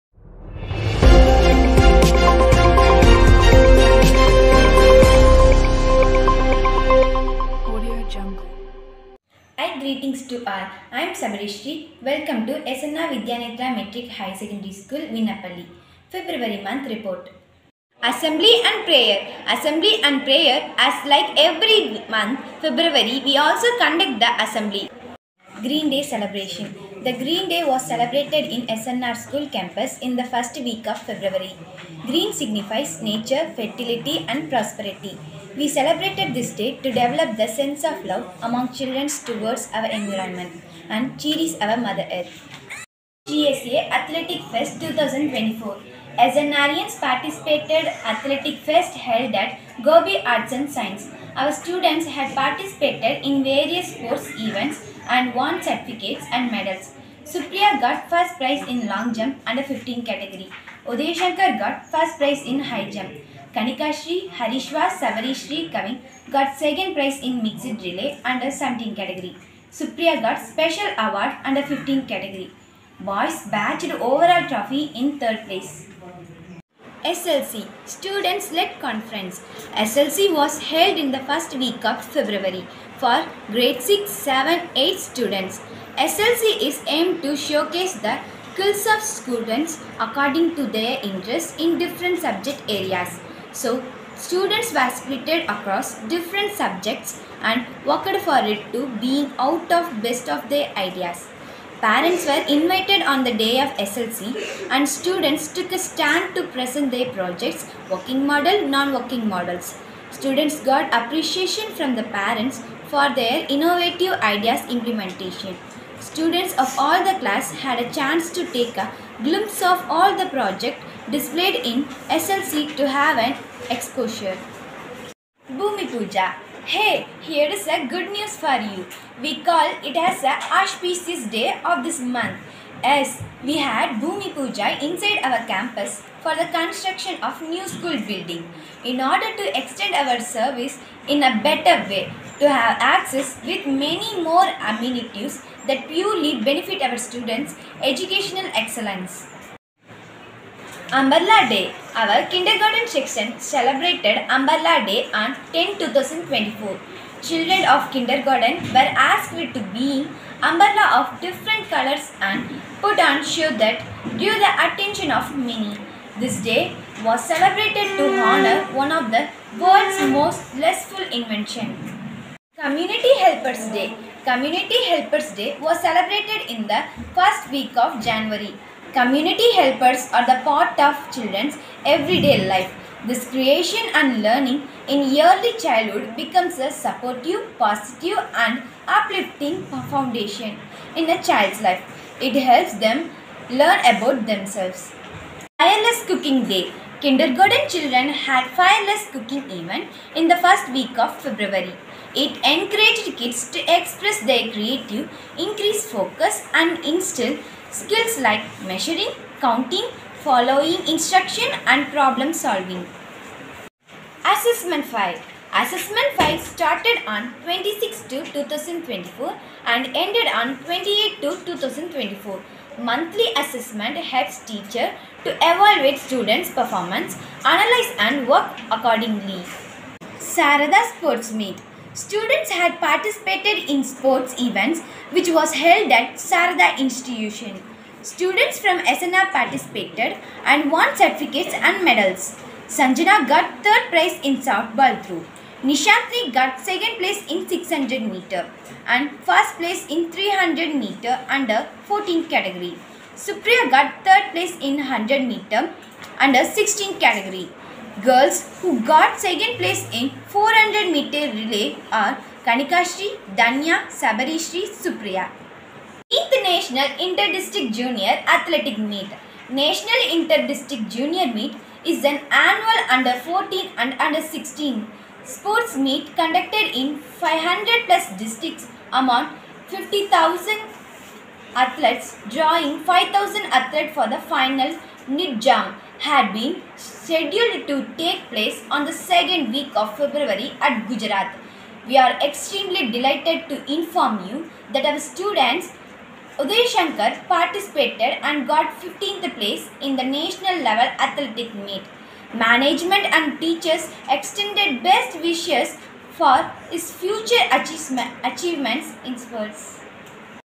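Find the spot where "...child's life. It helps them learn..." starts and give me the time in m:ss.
3:11.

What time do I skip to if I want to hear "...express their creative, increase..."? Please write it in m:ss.
3:23.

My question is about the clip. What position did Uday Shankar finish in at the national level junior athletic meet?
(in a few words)
15th place.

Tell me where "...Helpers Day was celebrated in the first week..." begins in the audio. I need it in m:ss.
2:54.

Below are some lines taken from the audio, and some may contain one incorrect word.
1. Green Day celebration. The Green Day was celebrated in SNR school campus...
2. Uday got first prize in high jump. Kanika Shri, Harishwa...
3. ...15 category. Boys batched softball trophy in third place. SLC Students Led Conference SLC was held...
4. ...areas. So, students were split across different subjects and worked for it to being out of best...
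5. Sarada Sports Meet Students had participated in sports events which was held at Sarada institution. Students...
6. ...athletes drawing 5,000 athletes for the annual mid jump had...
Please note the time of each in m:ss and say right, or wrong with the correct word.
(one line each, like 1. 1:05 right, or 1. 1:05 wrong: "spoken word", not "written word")
1. 0:25 right
2. 1:00 right
3. 1:11 wrong: "overall", not "softball"
4. 1:32 right
5. 3:50 right
6. 4:41 wrong: "final", not "annual".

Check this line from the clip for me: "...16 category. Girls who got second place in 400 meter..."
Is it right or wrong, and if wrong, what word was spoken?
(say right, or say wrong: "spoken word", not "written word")
right.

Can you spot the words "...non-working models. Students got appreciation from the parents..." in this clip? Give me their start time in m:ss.
1:48.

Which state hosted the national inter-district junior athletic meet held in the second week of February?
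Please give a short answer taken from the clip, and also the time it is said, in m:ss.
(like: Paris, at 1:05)
Gujarat, at 4:50.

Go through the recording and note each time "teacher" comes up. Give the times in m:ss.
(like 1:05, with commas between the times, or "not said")
3:44, 5:03.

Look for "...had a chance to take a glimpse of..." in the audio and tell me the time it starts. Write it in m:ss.
1:57.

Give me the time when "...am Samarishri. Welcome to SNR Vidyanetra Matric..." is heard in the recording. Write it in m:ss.
0:11.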